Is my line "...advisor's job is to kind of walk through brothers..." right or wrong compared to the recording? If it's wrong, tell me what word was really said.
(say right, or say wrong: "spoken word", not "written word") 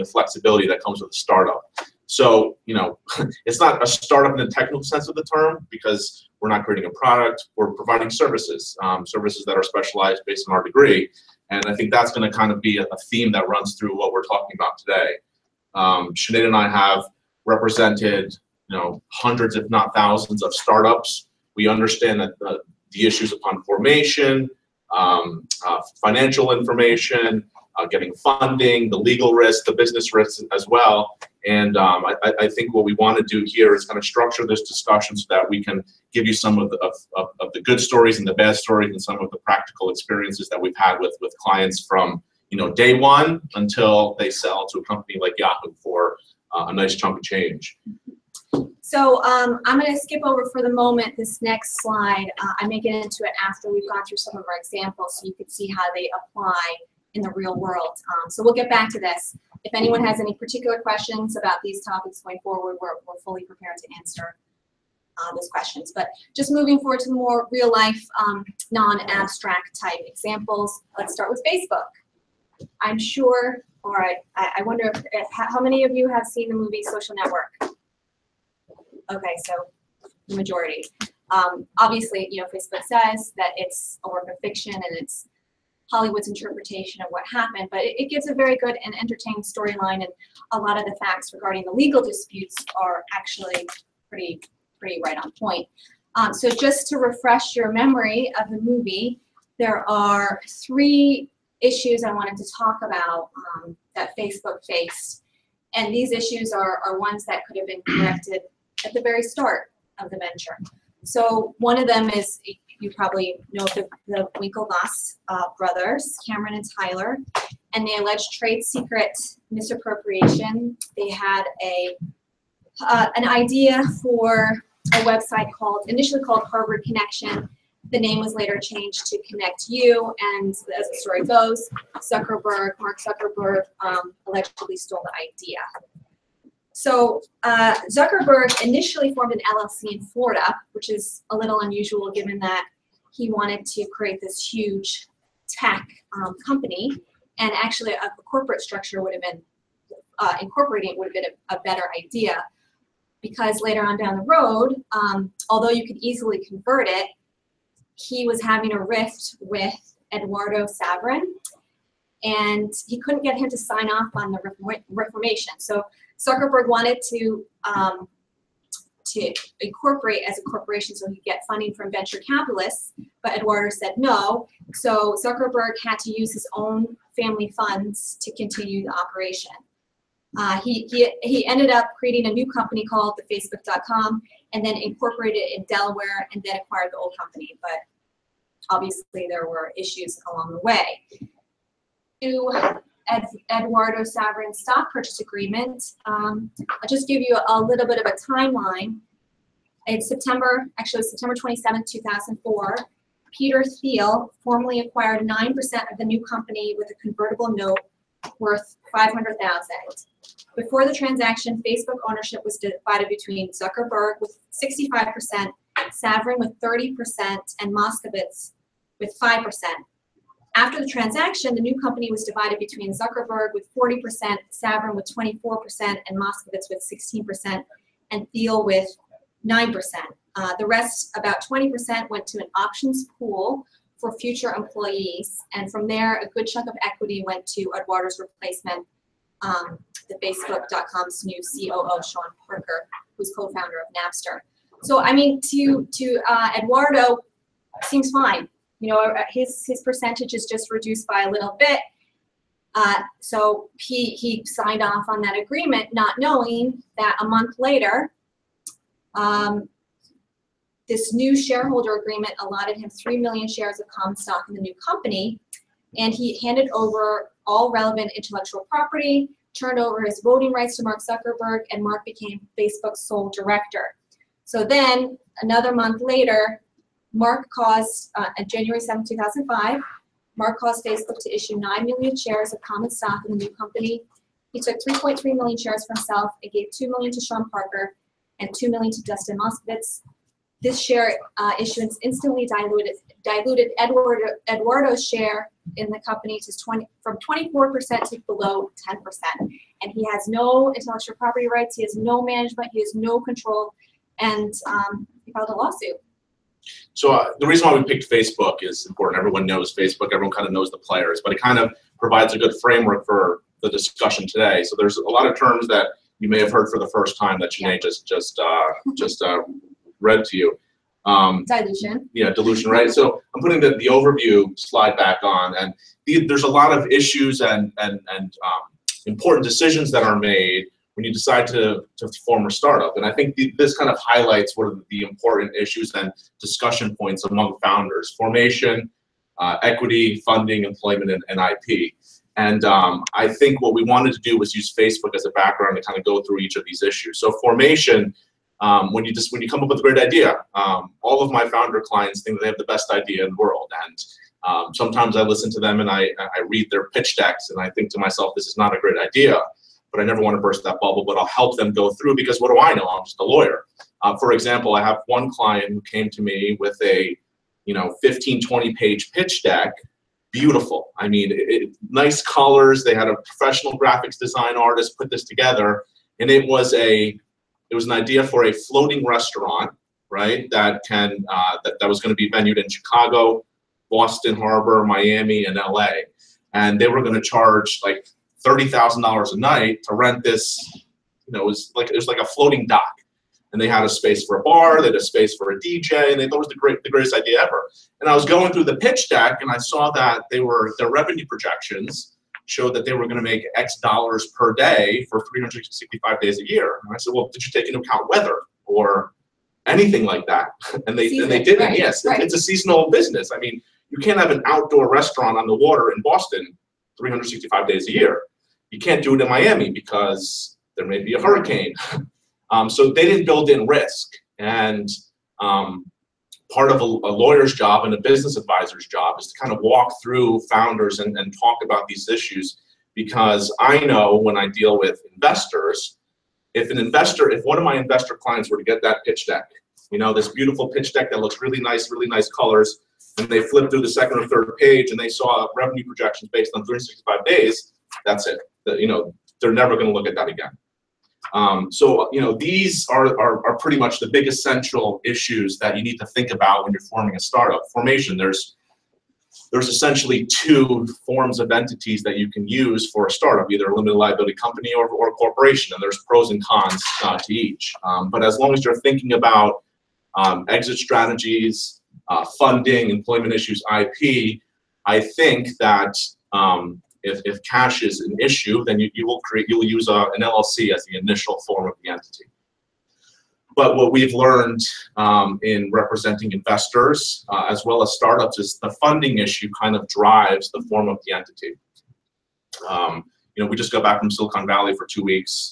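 wrong: "founders", not "brothers".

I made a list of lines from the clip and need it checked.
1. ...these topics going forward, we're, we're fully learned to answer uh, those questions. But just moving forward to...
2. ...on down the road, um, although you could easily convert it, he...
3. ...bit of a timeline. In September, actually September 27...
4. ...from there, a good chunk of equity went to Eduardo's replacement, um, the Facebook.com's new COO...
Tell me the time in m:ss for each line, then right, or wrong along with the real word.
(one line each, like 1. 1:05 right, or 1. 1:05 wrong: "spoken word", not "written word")
1. 1:01 wrong: "prepared", not "learned"
2. 2:33 right
3. 3:17 right
4. 3:55 right.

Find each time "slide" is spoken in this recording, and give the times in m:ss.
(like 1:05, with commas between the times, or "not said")
0:51, 5:24.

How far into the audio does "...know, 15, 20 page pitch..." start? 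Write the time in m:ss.
6:07.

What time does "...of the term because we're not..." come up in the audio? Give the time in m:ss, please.
0:05.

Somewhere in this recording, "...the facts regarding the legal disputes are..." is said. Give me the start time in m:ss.
1:30.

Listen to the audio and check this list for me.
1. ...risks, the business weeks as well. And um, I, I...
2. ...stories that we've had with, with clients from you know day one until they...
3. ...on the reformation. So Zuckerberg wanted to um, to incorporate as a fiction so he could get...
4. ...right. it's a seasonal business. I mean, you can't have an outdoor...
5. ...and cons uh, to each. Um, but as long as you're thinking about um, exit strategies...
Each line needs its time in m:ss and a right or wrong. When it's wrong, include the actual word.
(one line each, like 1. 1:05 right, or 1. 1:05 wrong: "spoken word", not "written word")
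1. 0:29 wrong: "risks", not "weeks"
2. 0:39 wrong: "experiences", not "stories"
3. 2:44 wrong: "corporation", not "fiction"
4. 6:52 right
5. 7:46 right.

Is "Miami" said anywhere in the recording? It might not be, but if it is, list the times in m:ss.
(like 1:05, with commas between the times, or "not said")
6:24, 6:59.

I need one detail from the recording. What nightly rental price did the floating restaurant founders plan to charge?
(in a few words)
$30,000.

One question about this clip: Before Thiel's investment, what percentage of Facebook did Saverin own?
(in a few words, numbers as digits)
30%.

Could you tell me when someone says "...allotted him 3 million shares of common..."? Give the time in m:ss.
4:22.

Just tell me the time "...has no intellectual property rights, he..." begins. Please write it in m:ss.
5:00.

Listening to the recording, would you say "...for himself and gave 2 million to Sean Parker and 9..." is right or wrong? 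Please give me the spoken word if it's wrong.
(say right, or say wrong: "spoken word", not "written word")
wrong: "2", not "9".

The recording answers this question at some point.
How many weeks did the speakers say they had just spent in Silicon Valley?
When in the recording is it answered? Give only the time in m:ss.
8:14.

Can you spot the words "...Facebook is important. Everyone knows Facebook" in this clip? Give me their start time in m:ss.
5:08.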